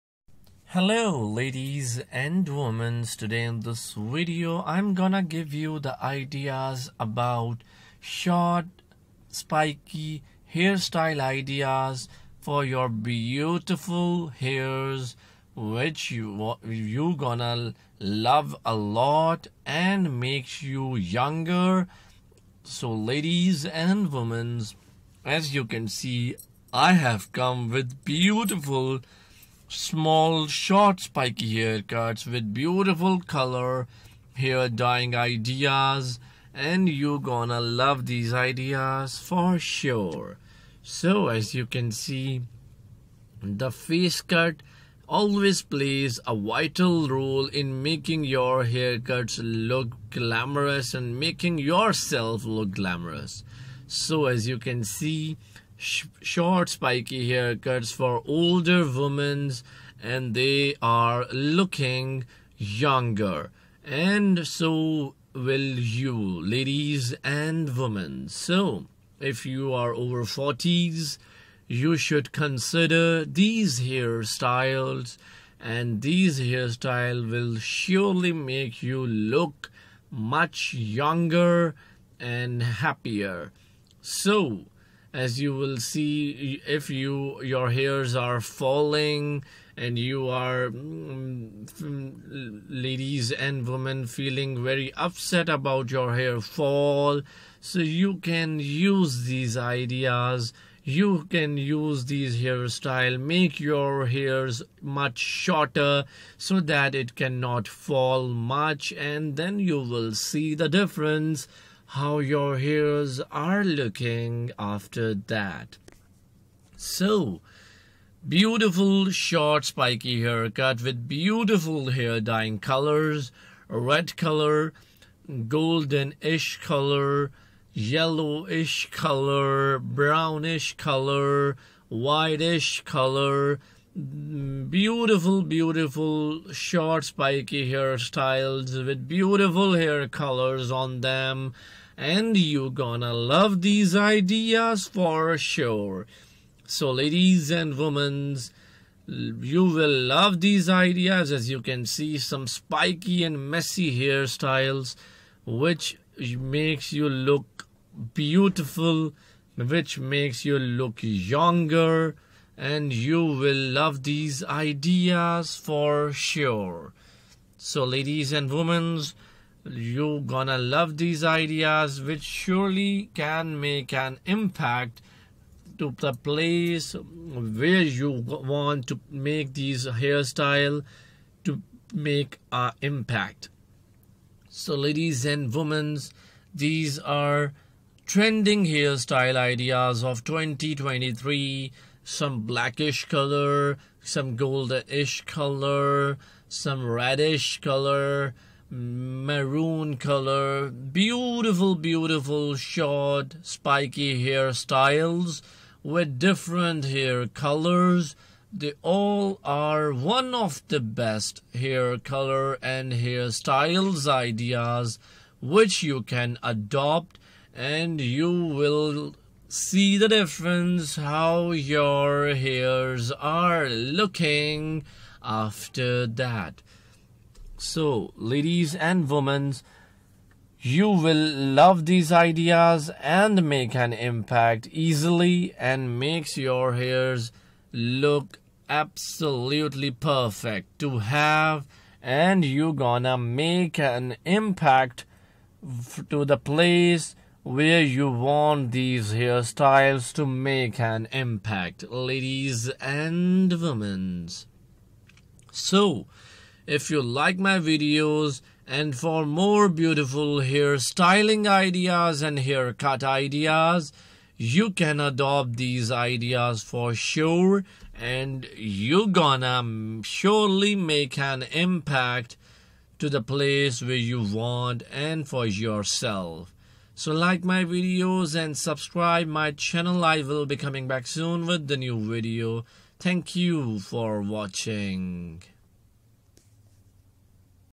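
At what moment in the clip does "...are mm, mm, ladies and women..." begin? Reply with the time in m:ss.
1:30.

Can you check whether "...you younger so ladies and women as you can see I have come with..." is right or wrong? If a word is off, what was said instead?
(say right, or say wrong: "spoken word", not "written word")
right.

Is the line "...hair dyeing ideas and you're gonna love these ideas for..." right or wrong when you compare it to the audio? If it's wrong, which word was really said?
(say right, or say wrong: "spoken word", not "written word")
right.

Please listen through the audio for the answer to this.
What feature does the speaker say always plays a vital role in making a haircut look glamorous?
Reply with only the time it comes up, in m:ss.
0:43.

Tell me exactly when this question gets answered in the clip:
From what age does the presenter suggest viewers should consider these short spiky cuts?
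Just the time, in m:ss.
1:10.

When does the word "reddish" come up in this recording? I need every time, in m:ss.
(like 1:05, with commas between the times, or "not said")
3:16.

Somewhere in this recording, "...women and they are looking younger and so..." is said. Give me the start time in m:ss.
0:58.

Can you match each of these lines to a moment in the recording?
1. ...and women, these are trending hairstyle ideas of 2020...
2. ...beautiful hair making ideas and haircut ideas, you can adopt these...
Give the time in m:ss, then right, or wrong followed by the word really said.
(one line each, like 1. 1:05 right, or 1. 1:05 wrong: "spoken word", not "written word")
1. 3:05 wrong: "2023", not "2020"
2. 4:19 wrong: "styling", not "making".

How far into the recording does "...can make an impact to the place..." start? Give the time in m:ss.
2:53.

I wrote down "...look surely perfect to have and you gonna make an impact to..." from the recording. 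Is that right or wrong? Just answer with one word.
wrong.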